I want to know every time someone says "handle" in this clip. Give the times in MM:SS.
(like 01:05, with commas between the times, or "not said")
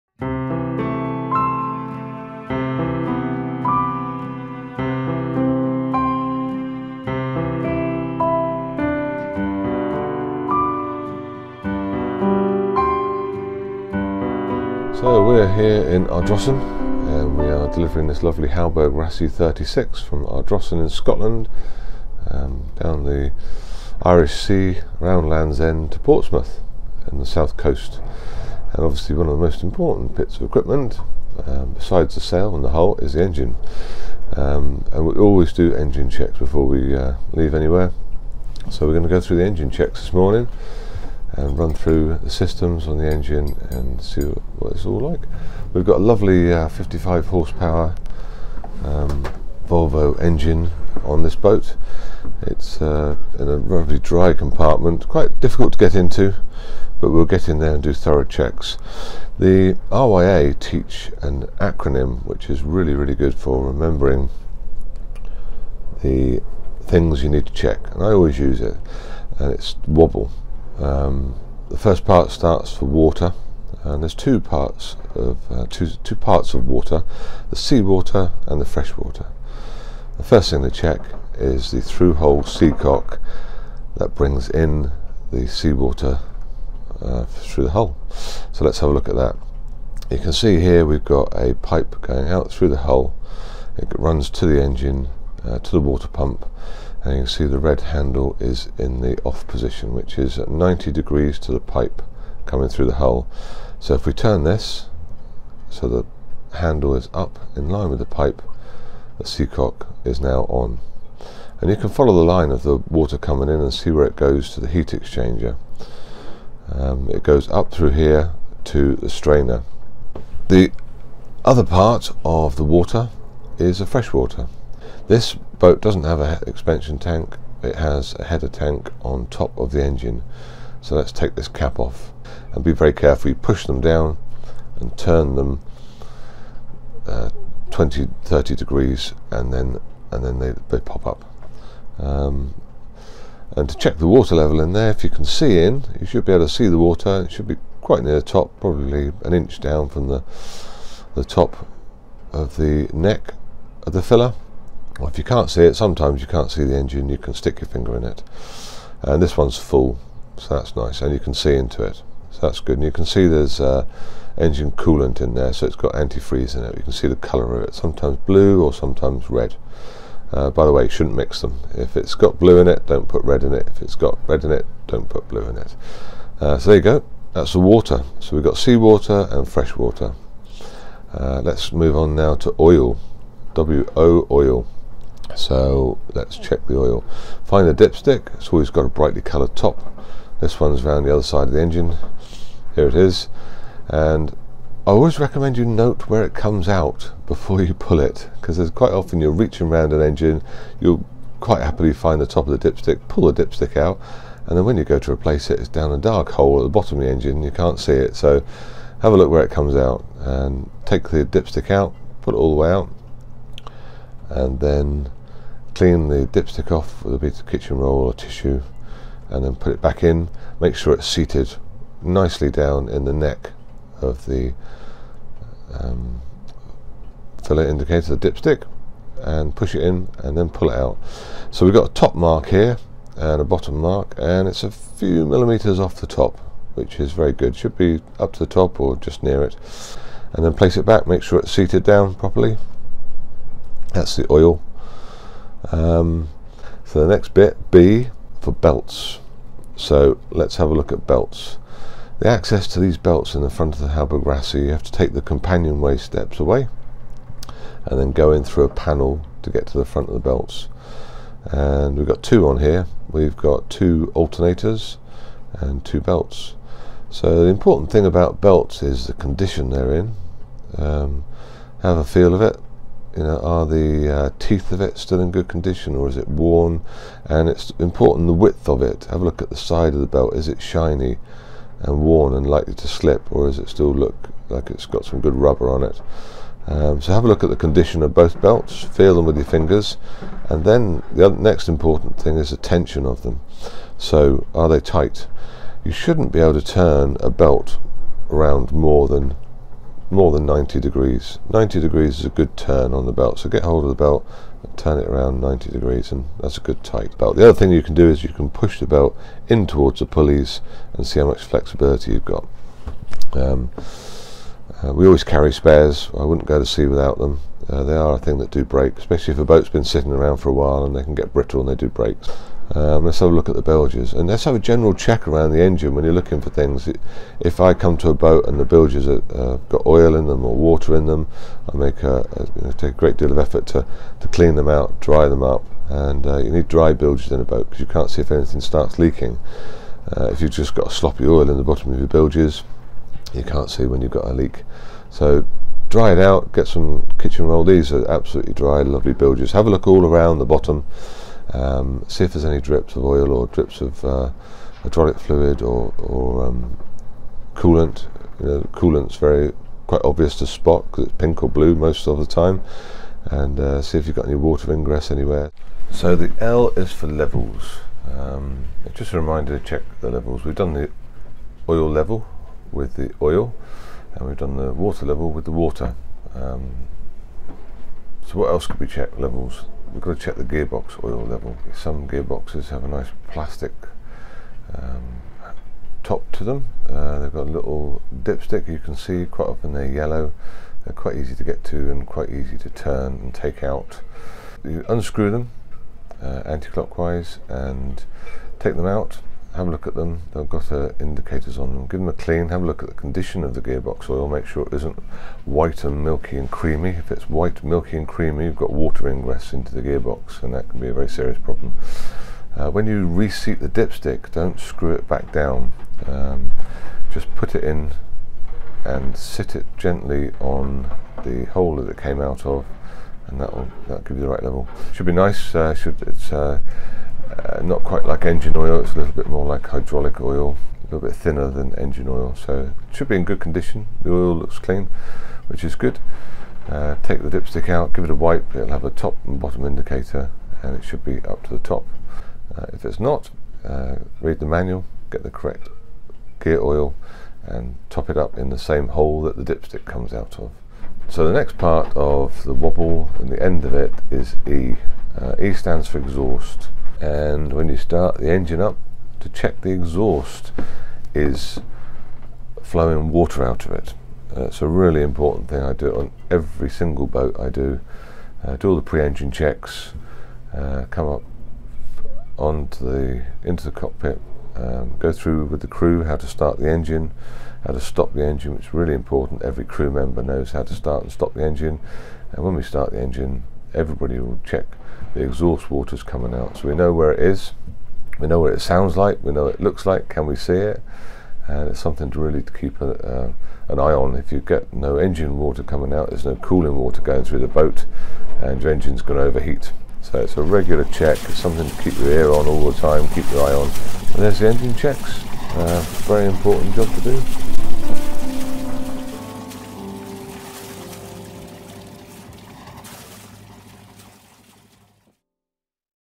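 01:37, 01:46.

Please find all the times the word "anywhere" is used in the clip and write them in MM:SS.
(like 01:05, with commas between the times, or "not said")
00:37, 06:05.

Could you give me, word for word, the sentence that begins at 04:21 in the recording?
And we've got two on here.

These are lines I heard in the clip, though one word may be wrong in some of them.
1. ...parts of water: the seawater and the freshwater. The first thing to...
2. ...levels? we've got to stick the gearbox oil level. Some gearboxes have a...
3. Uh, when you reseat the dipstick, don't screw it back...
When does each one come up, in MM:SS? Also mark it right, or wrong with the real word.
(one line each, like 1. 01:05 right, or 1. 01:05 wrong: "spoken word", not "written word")
1. 01:16 right
2. 06:19 wrong: "check", not "stick"
3. 06:52 right.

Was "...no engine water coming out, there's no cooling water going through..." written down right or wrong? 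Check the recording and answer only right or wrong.
right.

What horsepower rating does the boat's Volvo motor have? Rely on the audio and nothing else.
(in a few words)
55.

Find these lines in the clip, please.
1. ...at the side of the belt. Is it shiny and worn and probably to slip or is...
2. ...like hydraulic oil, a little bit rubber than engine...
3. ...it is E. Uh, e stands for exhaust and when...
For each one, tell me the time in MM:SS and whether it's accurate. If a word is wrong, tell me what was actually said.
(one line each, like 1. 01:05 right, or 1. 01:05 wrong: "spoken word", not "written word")
1. 04:39 wrong: "likely", not "probably"
2. 07:09 wrong: "thinner", not "rubber"
3. 07:33 right.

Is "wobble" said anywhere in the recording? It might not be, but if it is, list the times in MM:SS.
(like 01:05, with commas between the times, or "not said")
01:09, 07:32.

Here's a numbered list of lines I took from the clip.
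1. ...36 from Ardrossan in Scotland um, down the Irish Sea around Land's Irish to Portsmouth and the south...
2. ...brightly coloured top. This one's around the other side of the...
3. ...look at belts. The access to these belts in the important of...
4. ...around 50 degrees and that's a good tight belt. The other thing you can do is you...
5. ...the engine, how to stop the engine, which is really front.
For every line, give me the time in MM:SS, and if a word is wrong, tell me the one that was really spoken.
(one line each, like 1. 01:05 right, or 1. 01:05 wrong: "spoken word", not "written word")
1. 00:19 wrong: "End", not "Irish"
2. 03:08 right
3. 04:10 wrong: "front", not "important"
4. 05:05 wrong: "90", not "50"
5. 07:56 wrong: "important", not "front".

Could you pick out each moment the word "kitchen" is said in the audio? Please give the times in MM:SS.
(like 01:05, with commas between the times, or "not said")
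03:37, 05:47.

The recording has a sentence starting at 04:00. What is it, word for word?
And then place it back, make sure it's seated down properly.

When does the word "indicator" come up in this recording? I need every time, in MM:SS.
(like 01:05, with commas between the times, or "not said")
03:47, 06:40, 07:19.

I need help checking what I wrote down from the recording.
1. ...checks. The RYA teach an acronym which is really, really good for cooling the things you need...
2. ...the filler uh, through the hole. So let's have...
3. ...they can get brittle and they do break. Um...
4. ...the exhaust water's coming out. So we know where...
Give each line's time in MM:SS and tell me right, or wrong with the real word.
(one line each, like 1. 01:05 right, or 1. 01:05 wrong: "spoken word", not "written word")
1. 00:58 wrong: "remembering", not "cooling"
2. 01:25 wrong: "seawater", not "filler"
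3. 05:20 right
4. 08:05 right.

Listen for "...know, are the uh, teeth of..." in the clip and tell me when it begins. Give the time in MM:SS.
04:33.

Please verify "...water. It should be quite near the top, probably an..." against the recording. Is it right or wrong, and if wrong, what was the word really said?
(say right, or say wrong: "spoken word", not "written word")
right.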